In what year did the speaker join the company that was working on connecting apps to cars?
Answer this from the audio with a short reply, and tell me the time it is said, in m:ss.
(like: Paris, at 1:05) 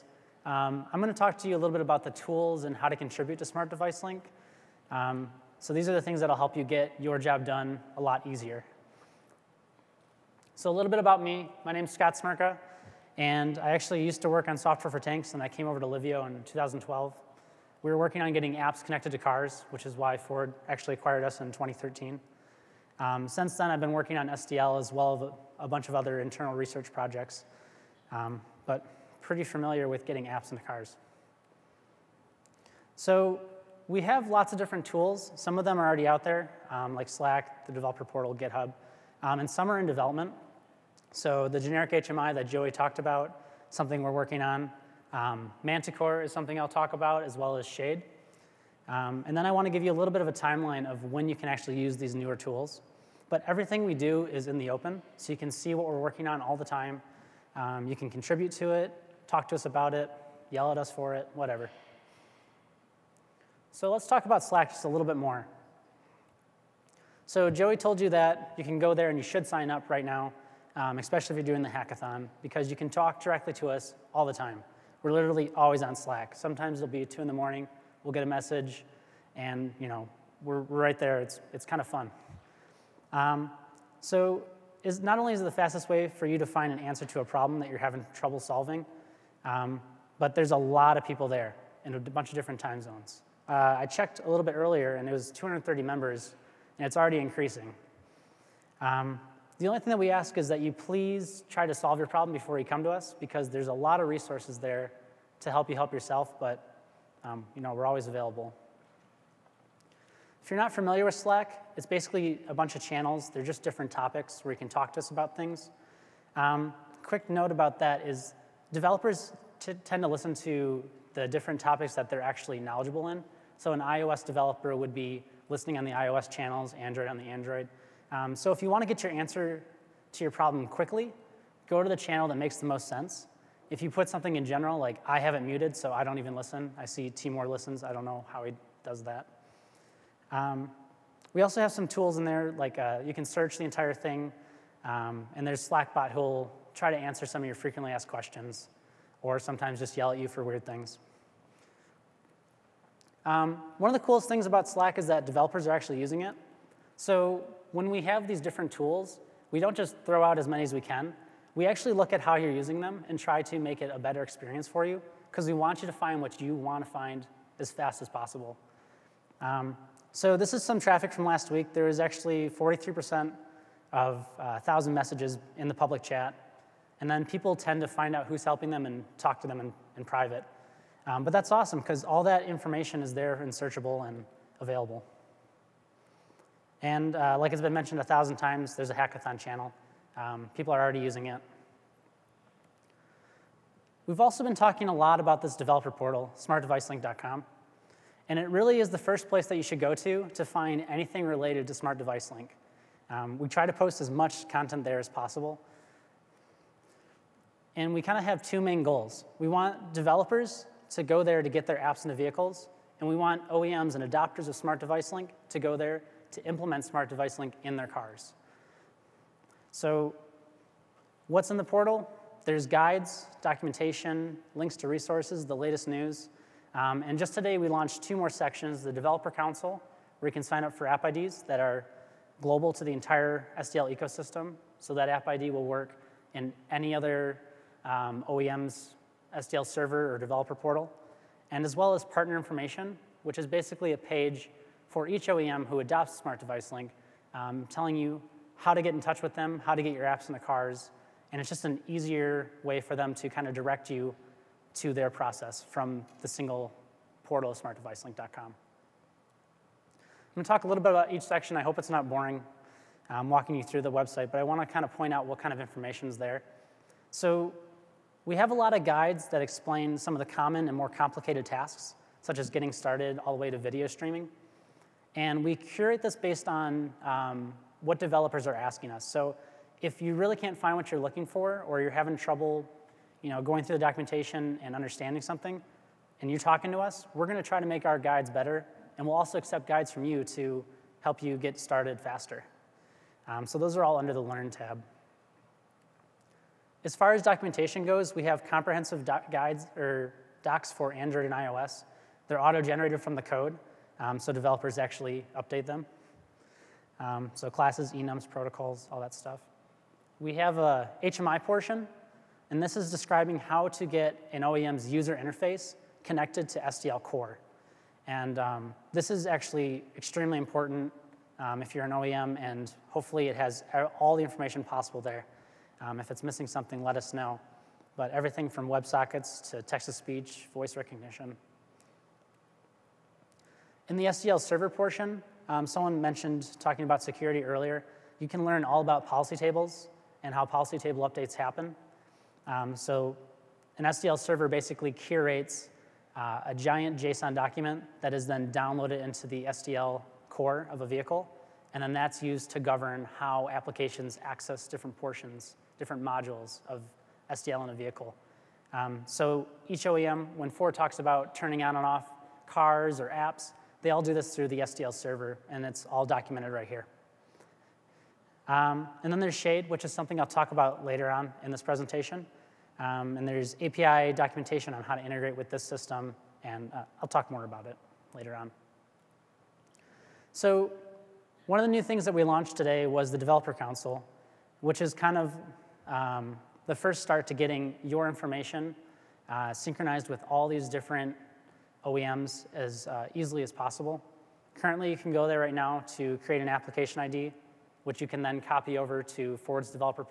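2012, at 0:16.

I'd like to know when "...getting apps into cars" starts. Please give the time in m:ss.
0:30.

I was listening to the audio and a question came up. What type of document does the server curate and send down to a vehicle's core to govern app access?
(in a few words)
JSON document.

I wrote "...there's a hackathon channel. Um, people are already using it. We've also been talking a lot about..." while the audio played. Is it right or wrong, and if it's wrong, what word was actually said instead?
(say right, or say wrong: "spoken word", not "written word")
right.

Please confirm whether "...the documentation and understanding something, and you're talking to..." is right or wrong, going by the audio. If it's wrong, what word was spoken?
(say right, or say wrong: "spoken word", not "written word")
right.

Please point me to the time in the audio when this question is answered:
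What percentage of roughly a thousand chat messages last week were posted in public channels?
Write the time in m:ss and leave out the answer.
2:52.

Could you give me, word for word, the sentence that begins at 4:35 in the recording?
And we curate this based on um, what developers are asking us.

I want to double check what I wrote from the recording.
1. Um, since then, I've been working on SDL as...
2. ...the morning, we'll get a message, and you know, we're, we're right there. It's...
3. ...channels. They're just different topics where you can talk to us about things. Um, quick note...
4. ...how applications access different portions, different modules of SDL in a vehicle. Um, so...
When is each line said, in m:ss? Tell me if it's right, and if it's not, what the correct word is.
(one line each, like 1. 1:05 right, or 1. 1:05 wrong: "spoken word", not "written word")
1. 0:22 right
2. 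1:17 right
3. 1:52 right
4. 5:53 right.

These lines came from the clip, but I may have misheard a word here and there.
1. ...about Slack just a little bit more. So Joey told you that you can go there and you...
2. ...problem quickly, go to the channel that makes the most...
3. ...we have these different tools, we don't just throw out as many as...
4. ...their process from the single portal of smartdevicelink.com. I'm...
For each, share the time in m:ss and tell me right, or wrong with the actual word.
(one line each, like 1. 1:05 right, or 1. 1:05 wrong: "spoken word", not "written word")
1. 1:04 right
2. 2:10 right
3. 2:37 right
4. 4:14 right.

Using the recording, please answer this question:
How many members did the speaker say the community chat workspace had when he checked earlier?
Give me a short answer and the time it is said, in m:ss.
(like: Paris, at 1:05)
230, at 1:35.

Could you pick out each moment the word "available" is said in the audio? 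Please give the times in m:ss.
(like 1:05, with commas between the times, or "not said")
1:48, 3:04.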